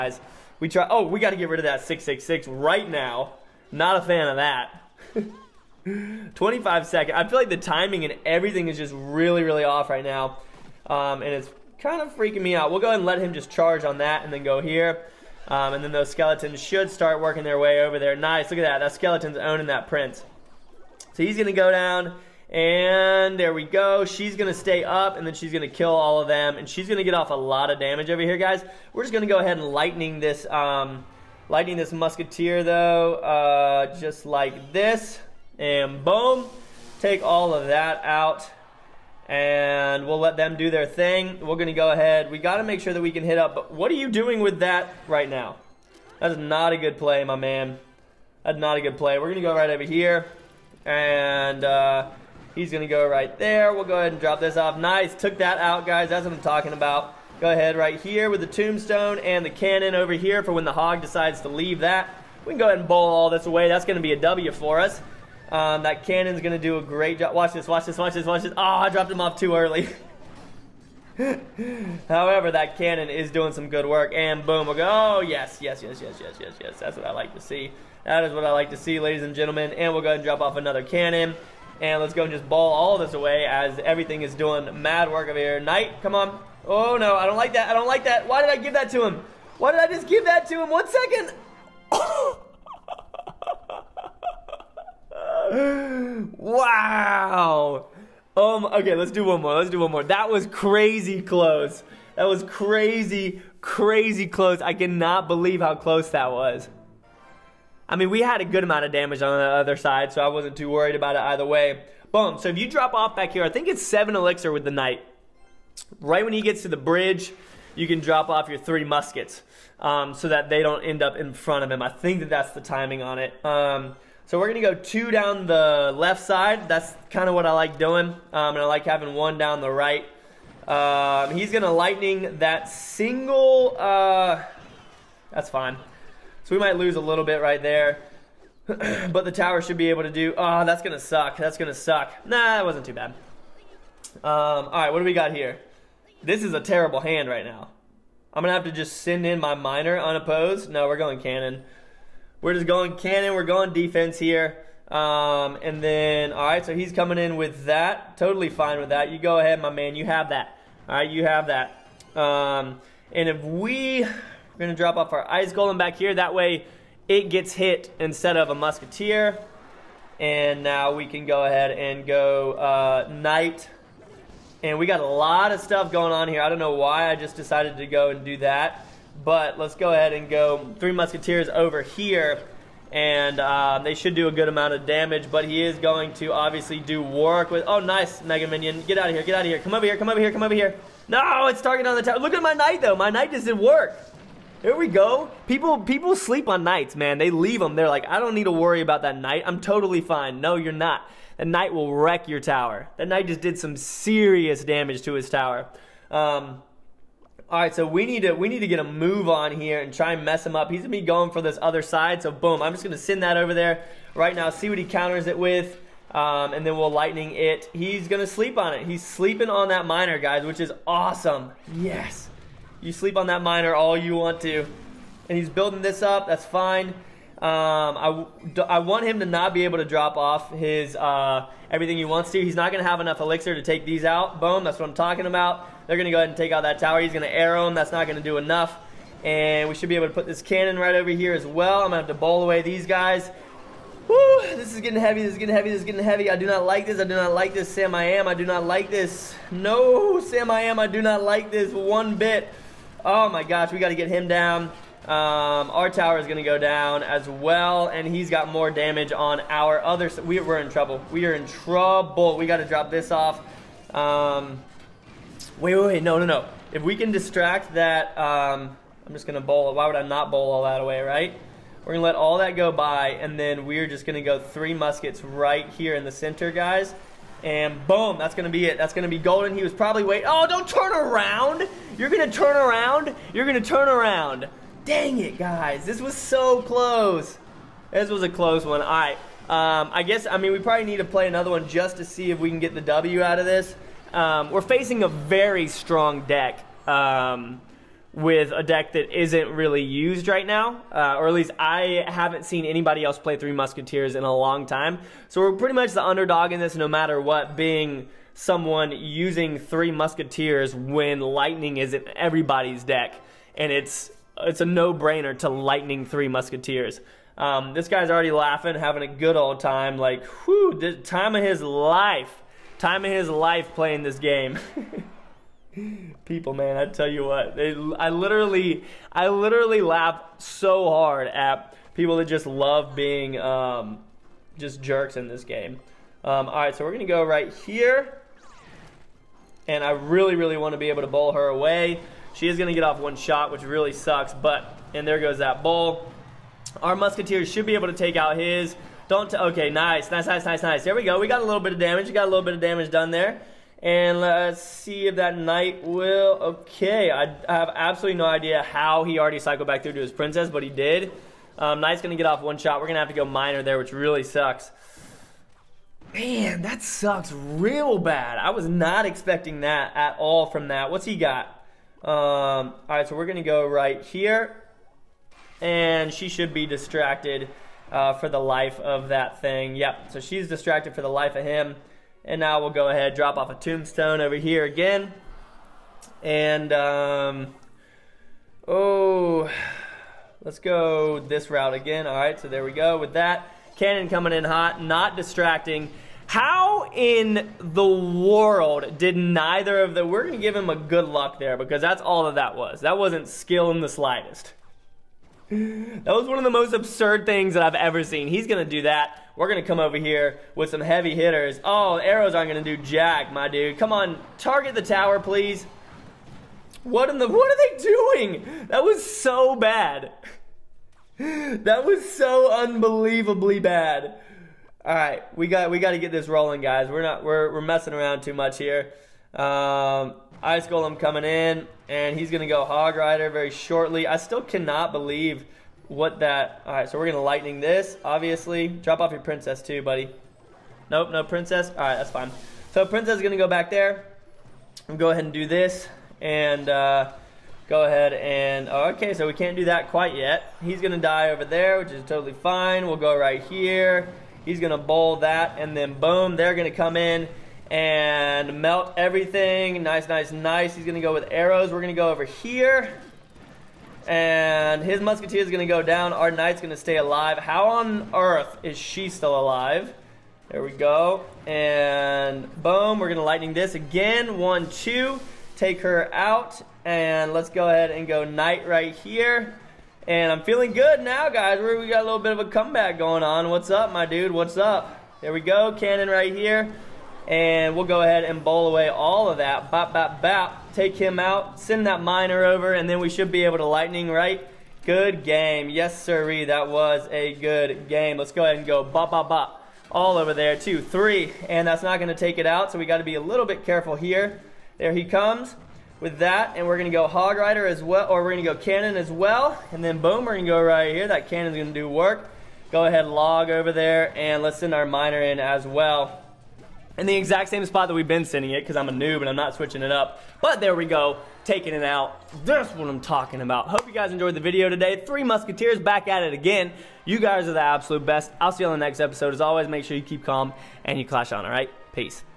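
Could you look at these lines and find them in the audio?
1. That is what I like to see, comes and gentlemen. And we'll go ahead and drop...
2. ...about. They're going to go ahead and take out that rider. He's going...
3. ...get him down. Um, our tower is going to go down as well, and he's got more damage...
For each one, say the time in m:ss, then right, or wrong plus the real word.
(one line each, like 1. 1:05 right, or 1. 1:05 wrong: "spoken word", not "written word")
1. 1:18 wrong: "ladies", not "comes"
2. 3:55 wrong: "tower", not "rider"
3. 4:13 right.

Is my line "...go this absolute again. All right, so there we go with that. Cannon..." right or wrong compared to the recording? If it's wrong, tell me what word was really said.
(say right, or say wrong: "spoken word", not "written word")
wrong: "route", not "absolute".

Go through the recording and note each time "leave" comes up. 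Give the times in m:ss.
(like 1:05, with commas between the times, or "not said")
1:01, 3:17.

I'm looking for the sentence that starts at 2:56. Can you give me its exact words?
I don't know why I just decided to go and do that.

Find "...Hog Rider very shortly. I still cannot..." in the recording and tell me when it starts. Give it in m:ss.
7:12.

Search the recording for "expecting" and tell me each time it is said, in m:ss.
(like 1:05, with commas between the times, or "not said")
6:09.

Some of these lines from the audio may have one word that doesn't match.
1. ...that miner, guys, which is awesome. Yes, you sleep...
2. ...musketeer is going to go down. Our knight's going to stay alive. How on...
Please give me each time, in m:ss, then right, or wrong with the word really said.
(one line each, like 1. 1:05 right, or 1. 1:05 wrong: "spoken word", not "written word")
1. 3:39 right
2. 7:45 right.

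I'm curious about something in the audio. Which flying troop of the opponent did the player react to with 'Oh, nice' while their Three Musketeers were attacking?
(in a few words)
Mega Minion.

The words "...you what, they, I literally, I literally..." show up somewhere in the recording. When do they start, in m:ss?
5:27.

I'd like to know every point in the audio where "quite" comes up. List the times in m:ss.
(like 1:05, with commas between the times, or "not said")
7:29.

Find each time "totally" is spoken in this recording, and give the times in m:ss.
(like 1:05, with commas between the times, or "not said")
2:38, 3:19, 7:32.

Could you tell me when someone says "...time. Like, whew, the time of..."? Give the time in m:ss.
5:19.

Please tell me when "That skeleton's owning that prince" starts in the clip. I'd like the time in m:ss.
0:18.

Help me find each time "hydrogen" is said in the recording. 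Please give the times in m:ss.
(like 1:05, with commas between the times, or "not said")
not said.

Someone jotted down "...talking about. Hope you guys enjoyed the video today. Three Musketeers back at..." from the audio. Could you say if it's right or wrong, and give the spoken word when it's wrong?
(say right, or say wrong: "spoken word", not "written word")
right.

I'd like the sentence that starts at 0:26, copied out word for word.
And she's going to get off a lot of damage over here, guys.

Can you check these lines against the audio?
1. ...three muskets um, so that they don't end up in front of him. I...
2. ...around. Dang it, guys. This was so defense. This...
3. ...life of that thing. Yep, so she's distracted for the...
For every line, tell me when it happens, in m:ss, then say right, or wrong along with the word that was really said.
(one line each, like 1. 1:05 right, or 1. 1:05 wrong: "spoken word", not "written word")
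1. 1:58 right
2. 4:43 wrong: "close", not "defense"
3. 6:18 right.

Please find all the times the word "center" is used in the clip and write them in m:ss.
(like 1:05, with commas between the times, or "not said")
4:36.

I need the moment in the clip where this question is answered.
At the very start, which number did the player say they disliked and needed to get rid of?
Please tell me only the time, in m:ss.
0:01.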